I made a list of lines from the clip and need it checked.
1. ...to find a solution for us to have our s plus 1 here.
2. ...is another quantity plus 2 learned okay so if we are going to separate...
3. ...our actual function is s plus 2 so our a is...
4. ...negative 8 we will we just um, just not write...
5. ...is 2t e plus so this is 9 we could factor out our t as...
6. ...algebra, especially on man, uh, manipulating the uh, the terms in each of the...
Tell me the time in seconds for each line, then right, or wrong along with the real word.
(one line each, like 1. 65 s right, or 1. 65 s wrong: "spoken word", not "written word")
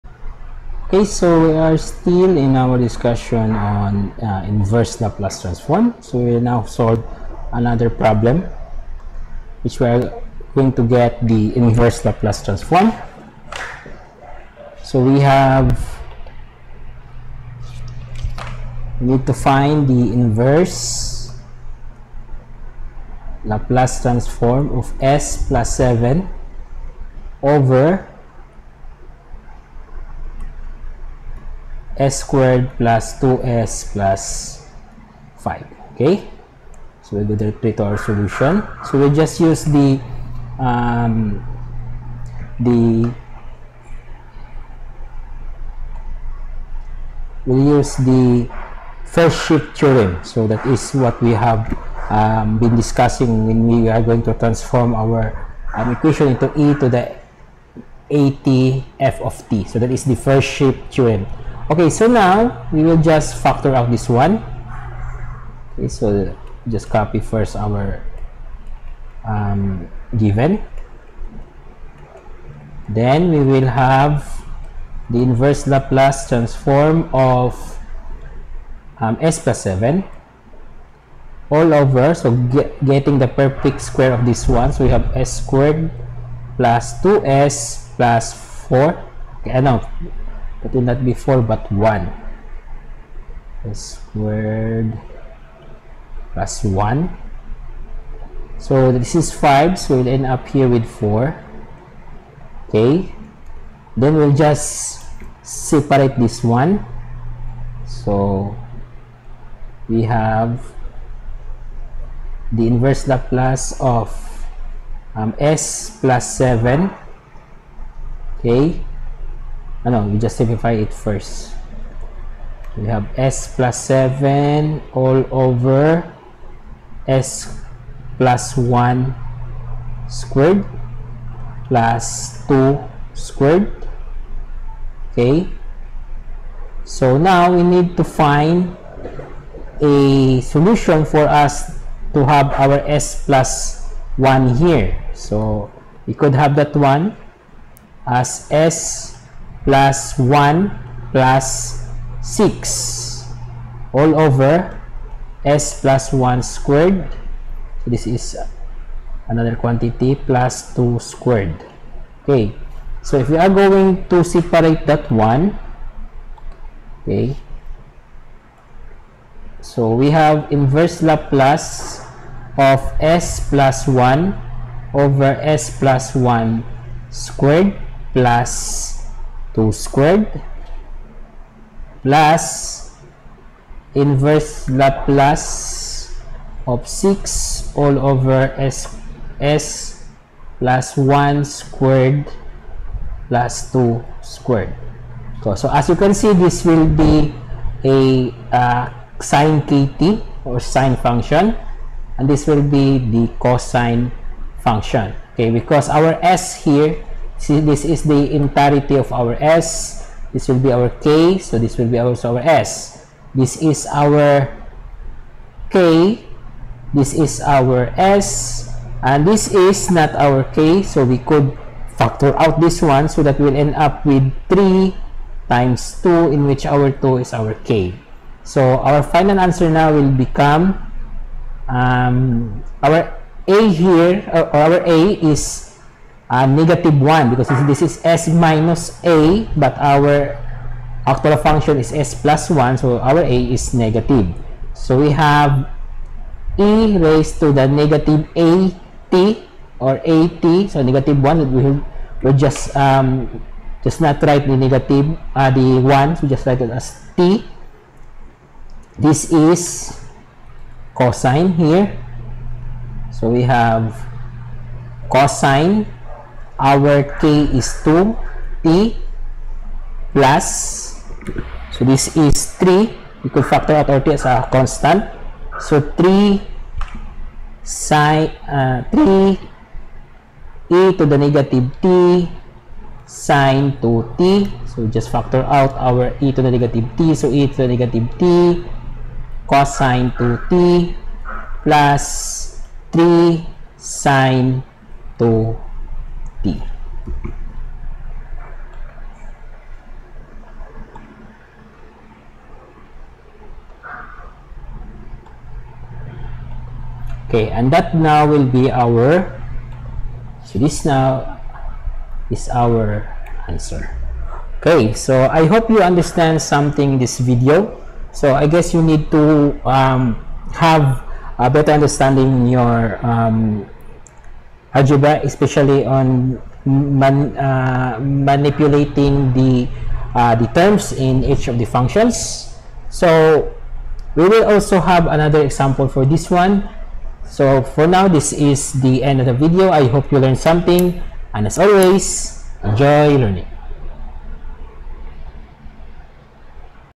1. 137 s right
2. 158 s wrong: "squared", not "learned"
3. 239 s wrong: "1", not "2"
4. 250 s wrong: "1", not "8"
5. 267 s wrong: "3", not "9"
6. 324 s right.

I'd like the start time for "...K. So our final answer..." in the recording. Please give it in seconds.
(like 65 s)
227 s.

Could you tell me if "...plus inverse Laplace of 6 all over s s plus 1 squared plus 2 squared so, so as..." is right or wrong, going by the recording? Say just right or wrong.
right.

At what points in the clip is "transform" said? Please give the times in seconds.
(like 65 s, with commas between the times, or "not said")
5 s, 12 s, 24 s, 54 s, 76 s.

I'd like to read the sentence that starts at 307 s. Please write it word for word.
Okay, and that now will be our, so this now is our answer.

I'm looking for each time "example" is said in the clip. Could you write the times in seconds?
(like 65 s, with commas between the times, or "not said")
335 s.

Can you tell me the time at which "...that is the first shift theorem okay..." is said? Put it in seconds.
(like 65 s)
59 s.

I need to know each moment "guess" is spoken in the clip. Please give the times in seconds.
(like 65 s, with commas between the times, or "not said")
318 s.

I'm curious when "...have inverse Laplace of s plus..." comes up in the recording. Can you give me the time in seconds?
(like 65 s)
170 s.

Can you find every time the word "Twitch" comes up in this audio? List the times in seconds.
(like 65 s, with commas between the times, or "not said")
not said.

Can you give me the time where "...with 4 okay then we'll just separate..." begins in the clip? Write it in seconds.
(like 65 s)
100 s.